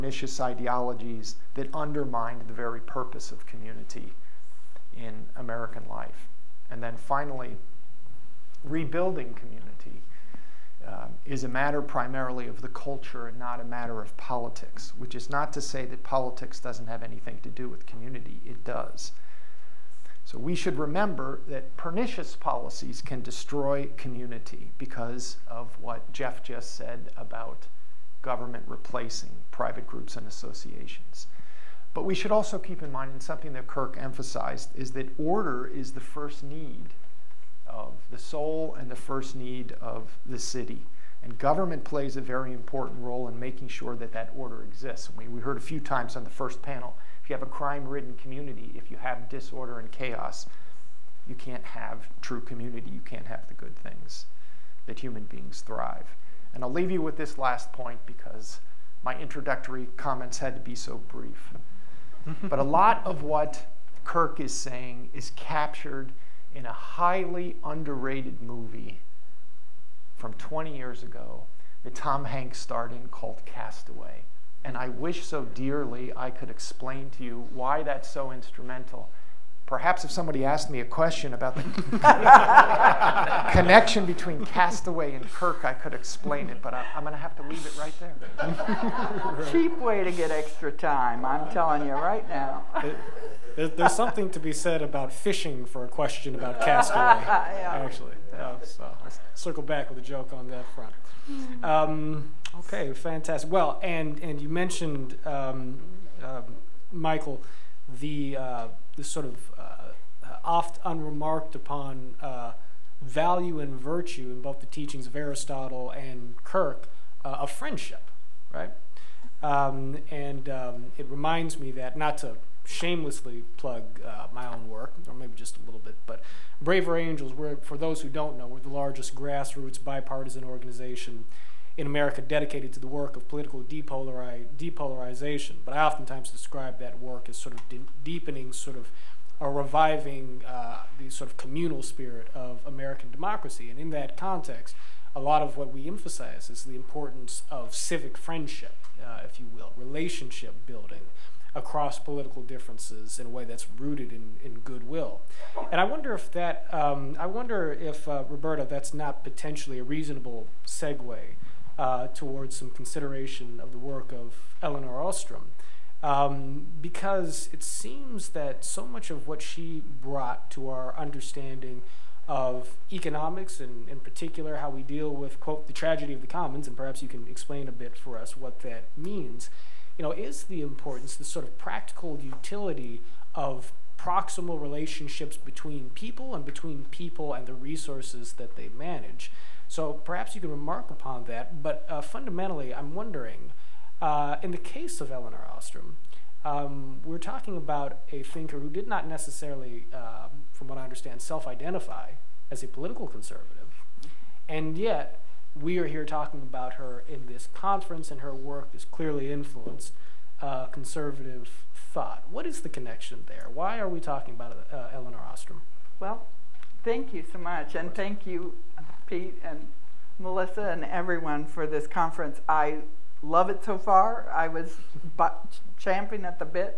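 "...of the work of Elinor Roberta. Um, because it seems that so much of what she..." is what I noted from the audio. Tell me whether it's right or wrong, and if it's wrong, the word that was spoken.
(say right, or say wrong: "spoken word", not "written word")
wrong: "Ostrom", not "Roberta".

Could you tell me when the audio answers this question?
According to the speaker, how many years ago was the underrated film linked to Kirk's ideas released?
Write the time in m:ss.
1:10.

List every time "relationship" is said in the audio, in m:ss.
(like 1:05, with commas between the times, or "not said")
2:29, 3:04.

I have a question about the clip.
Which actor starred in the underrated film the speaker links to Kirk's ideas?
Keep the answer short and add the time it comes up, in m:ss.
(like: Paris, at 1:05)
Tom Hanks, at 1:11.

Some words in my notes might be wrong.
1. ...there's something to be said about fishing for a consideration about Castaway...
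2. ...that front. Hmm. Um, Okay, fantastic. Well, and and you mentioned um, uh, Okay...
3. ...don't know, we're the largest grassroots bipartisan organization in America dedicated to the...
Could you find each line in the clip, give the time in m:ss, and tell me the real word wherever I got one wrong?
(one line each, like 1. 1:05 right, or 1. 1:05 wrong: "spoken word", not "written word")
1. 1:33 wrong: "question", not "consideration"
2. 1:40 wrong: "Michael", not "Okay"
3. 2:08 right.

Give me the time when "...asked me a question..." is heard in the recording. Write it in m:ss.
1:20.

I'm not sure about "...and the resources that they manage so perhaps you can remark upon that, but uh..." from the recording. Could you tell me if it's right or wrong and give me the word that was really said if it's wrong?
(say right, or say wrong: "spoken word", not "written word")
right.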